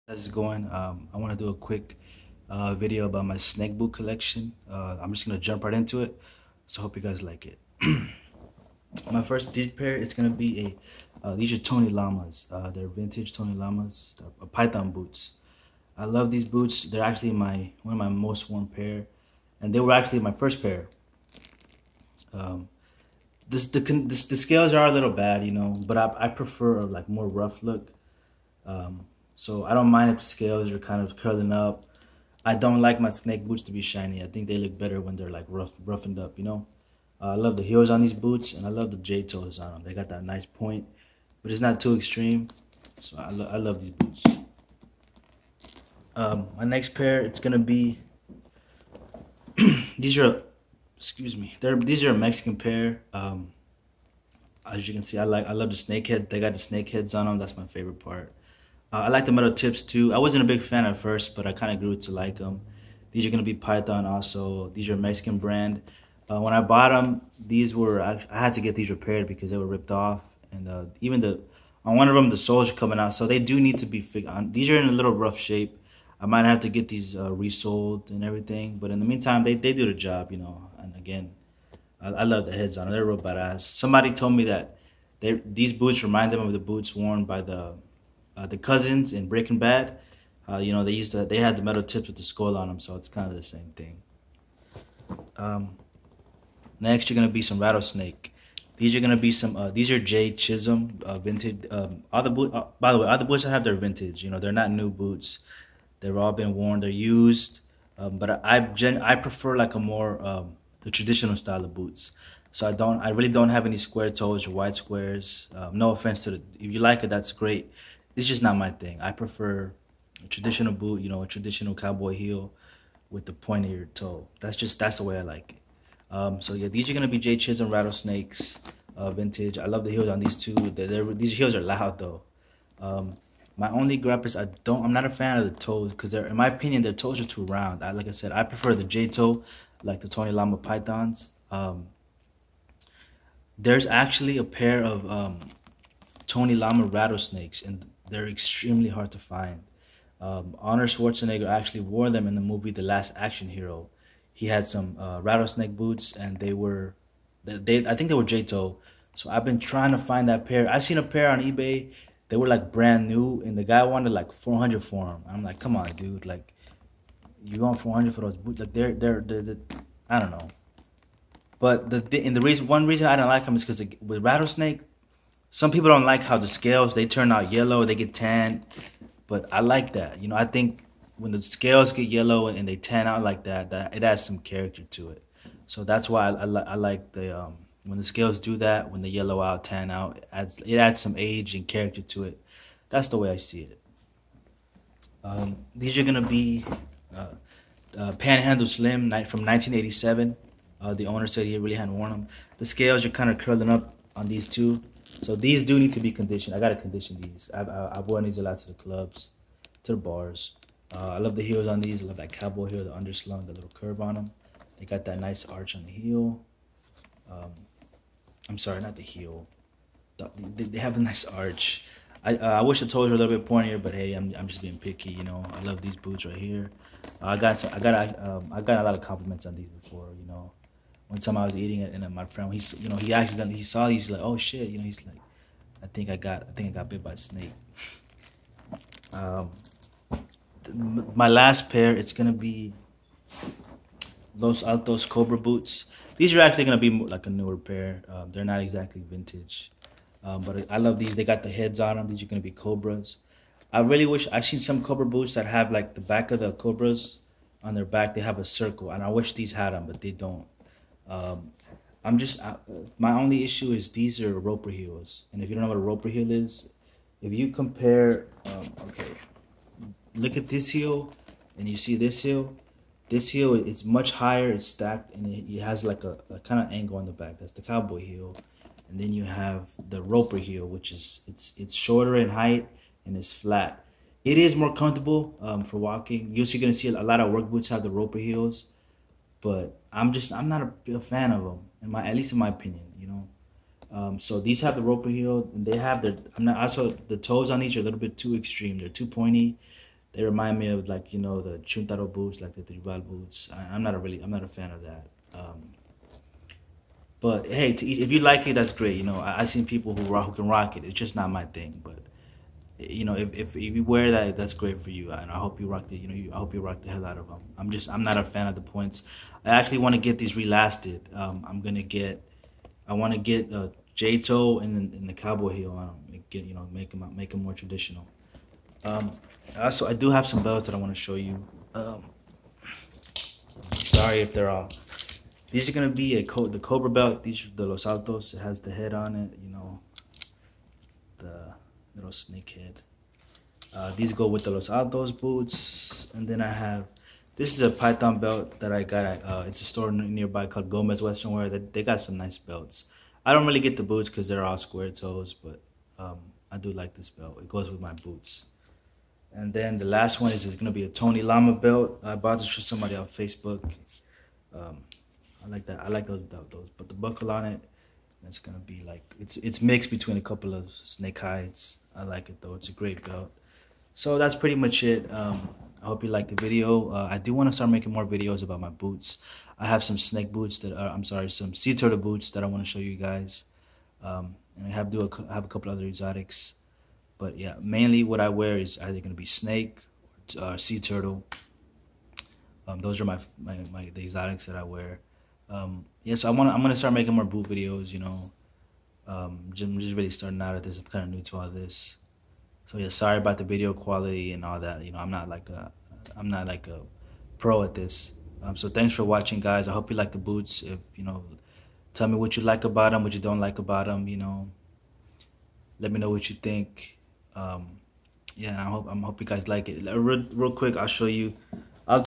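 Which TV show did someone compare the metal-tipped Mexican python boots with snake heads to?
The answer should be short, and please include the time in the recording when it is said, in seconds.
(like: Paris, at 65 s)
Breaking Bad, at 89 s.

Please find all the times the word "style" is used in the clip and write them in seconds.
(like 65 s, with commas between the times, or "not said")
111 s.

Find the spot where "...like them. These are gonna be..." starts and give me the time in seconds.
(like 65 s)
62 s.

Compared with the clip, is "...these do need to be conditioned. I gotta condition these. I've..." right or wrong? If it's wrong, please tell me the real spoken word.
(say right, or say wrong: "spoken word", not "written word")
right.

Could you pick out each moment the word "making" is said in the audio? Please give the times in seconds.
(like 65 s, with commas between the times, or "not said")
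377 s, 396 s.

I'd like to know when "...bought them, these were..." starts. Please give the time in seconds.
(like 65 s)
66 s.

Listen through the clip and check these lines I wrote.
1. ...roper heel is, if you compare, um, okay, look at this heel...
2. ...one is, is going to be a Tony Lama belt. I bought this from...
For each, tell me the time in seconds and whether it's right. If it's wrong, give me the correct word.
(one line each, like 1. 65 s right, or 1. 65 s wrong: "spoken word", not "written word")
1. 265 s right
2. 360 s right.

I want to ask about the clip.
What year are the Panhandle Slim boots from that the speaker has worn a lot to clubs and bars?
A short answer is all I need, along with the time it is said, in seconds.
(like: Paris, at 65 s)
1987, at 199 s.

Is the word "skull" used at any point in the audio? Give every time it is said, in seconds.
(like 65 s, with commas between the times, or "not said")
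92 s.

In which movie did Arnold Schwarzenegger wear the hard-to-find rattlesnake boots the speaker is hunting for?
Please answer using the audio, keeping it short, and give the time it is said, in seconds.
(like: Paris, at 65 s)
The Last Action Hero, at 152 s.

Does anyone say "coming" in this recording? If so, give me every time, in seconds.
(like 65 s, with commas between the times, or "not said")
72 s.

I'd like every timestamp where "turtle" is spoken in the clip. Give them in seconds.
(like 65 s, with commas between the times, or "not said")
381 s, 390 s.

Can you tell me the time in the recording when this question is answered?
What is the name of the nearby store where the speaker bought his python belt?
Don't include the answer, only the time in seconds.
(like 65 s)
350 s.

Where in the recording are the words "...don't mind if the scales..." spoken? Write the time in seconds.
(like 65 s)
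29 s.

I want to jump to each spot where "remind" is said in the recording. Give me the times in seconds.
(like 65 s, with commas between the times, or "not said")
86 s, 300 s.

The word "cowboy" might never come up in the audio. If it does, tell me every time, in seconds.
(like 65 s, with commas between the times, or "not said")
121 s, 212 s, 277 s, 325 s.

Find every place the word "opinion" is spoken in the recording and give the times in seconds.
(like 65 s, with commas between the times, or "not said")
136 s, 292 s.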